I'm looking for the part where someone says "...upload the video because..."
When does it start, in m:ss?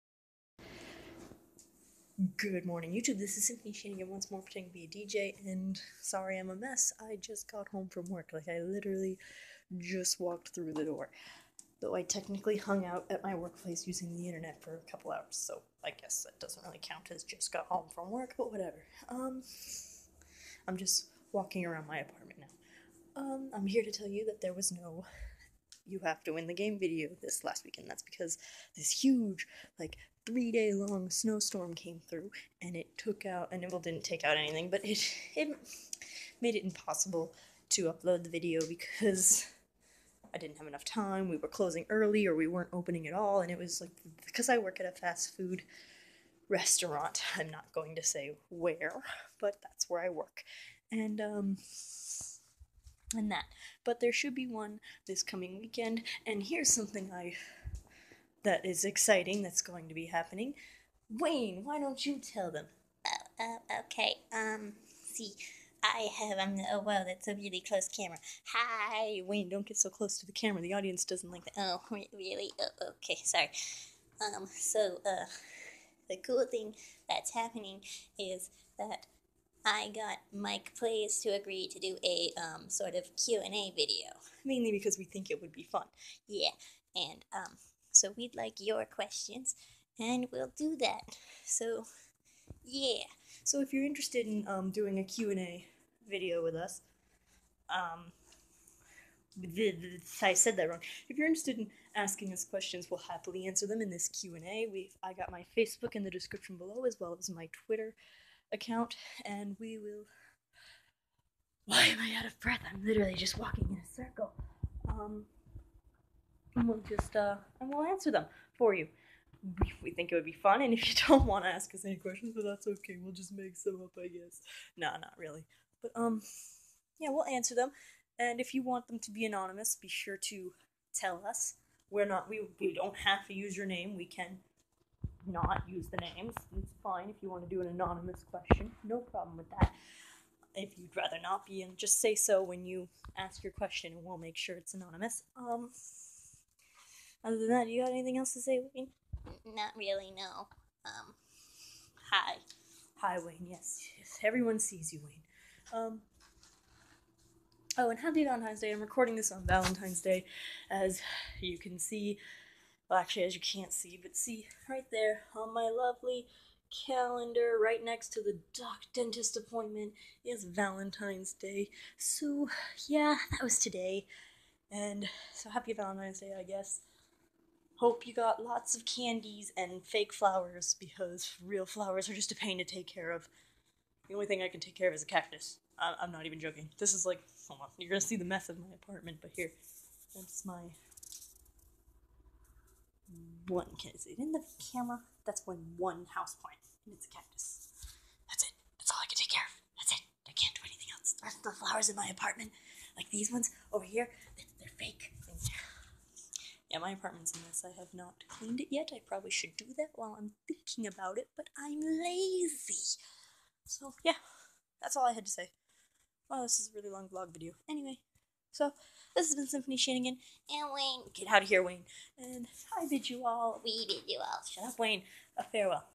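0:37.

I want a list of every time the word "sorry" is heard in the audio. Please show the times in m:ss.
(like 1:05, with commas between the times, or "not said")
0:06, 1:13.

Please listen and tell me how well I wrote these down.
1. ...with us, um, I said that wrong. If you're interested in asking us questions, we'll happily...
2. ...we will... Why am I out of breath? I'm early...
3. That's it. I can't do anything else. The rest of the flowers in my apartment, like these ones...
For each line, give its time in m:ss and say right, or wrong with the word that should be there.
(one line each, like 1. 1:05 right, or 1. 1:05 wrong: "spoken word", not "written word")
1. 1:36 right
2. 1:49 wrong: "literally", not "early"
3. 3:19 right.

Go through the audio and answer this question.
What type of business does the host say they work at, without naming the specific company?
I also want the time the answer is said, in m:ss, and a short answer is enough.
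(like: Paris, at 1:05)
fast food restaurant, at 0:44.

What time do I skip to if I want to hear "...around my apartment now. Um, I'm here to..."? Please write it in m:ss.
0:21.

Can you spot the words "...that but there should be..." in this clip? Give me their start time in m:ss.
0:53.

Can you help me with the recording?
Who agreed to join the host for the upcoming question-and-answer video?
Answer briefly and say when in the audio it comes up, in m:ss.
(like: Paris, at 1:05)
Mike Plays, at 1:20.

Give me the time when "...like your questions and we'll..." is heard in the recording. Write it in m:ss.
1:28.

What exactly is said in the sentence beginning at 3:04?
The only thing I can take care of is a cactus.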